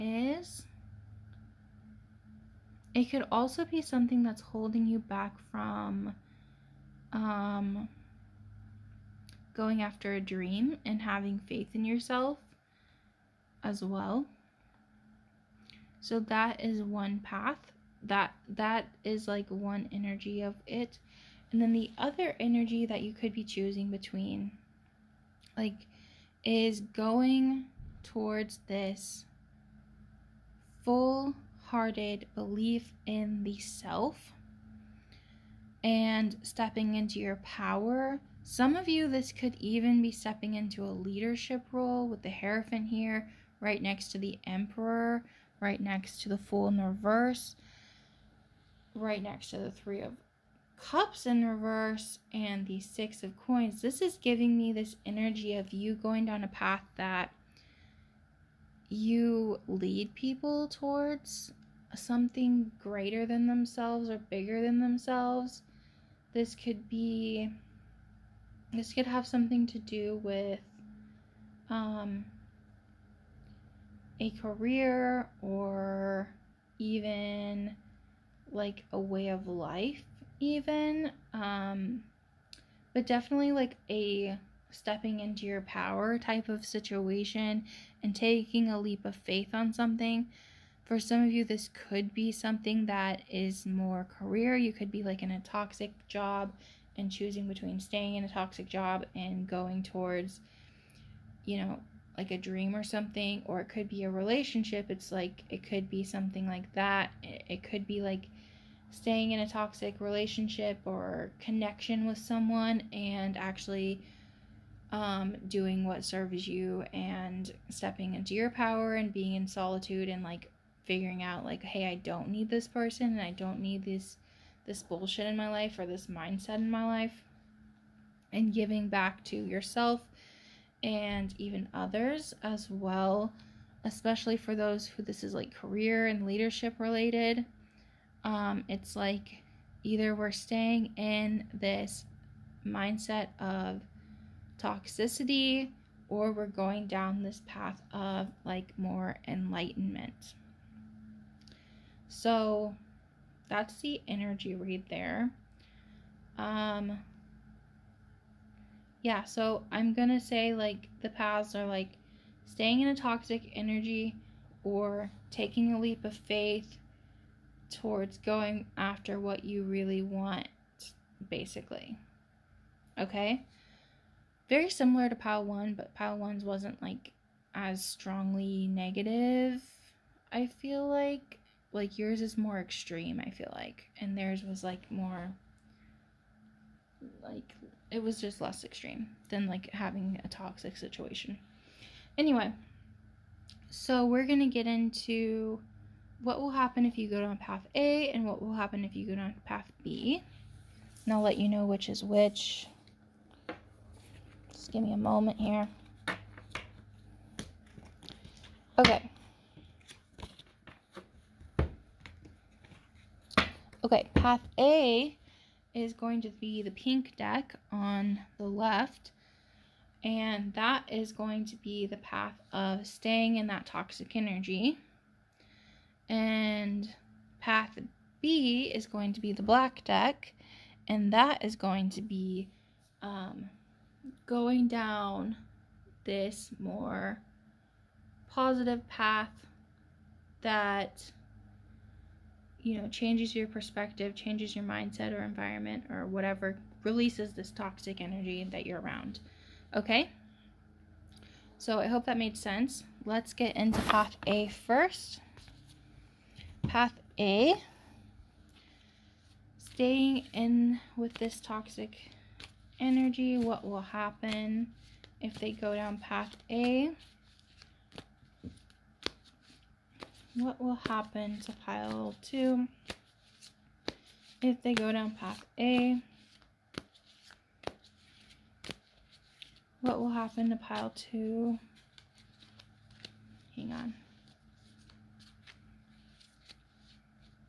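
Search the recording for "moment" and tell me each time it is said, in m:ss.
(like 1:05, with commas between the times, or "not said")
3:24.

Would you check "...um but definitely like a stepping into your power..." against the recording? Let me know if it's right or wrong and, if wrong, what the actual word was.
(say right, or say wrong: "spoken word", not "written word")
right.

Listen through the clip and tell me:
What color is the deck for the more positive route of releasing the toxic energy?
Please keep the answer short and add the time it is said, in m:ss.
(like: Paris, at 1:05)
Black, at 3:49.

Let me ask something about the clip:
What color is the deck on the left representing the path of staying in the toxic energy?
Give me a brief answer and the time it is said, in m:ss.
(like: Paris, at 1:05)
Pink, at 3:36.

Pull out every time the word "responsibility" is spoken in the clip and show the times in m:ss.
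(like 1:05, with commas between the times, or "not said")
not said.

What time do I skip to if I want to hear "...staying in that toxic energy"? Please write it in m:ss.
3:42.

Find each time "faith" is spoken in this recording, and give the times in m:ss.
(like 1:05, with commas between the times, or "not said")
0:11, 1:29, 2:46.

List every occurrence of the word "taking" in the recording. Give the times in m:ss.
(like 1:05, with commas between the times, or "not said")
1:28, 2:45.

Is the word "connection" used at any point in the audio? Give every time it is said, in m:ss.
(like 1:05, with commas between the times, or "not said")
1:51.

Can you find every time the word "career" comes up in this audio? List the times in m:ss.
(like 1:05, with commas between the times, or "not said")
1:14, 1:34, 2:15.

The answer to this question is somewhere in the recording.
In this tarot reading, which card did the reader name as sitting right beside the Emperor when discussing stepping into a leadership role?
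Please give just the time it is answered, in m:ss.
0:42.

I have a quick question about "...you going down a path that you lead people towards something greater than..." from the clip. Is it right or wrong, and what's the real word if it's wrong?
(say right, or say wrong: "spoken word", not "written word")
right.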